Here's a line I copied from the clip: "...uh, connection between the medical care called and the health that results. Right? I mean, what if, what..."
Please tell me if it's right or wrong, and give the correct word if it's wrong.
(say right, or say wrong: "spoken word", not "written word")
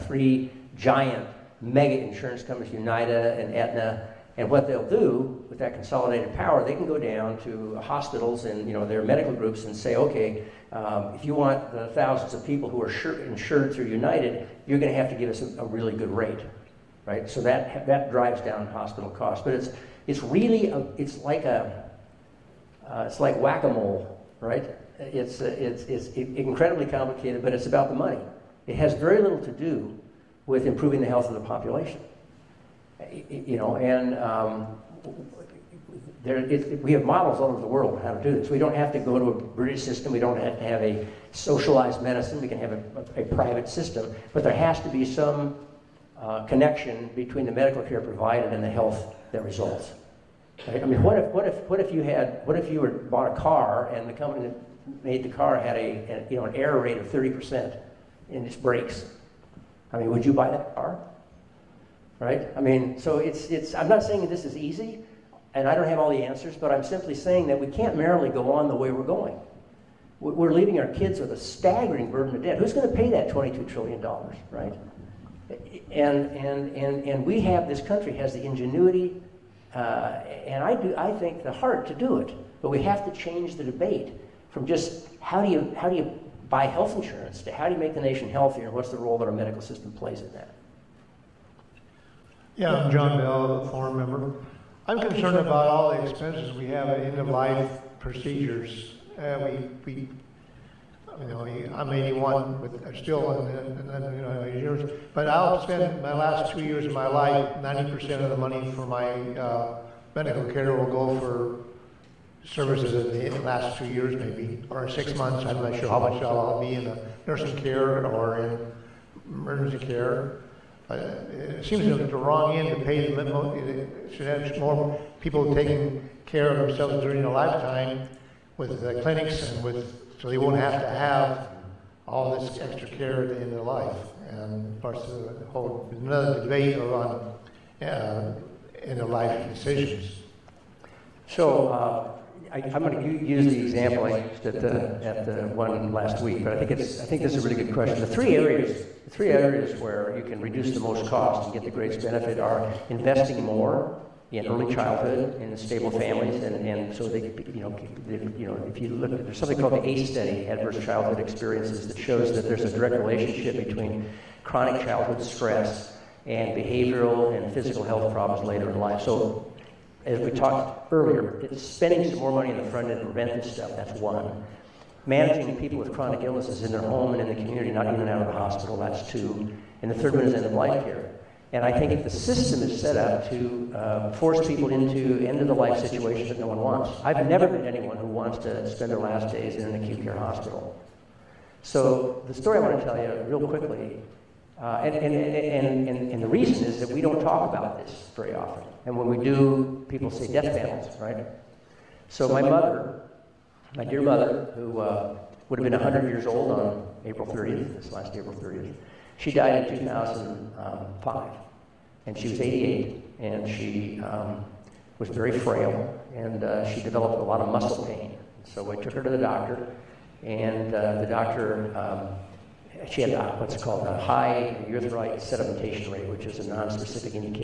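wrong: "provided", not "called".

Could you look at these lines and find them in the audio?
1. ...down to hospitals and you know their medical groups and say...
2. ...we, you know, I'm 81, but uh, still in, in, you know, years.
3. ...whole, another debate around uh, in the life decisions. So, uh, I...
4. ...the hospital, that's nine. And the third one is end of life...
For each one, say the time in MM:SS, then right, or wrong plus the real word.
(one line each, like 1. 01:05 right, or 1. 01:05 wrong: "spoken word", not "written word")
1. 00:06 right
2. 01:39 right
3. 02:15 right
4. 02:58 wrong: "two", not "nine".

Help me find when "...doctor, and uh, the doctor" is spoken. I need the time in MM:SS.
03:39.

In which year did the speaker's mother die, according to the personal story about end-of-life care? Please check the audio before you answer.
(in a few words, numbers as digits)
2005.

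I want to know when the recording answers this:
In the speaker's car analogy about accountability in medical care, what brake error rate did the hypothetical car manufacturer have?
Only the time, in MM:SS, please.
00:57.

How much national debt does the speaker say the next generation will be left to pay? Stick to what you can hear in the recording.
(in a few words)
$22 trillion.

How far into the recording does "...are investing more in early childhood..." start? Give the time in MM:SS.
02:32.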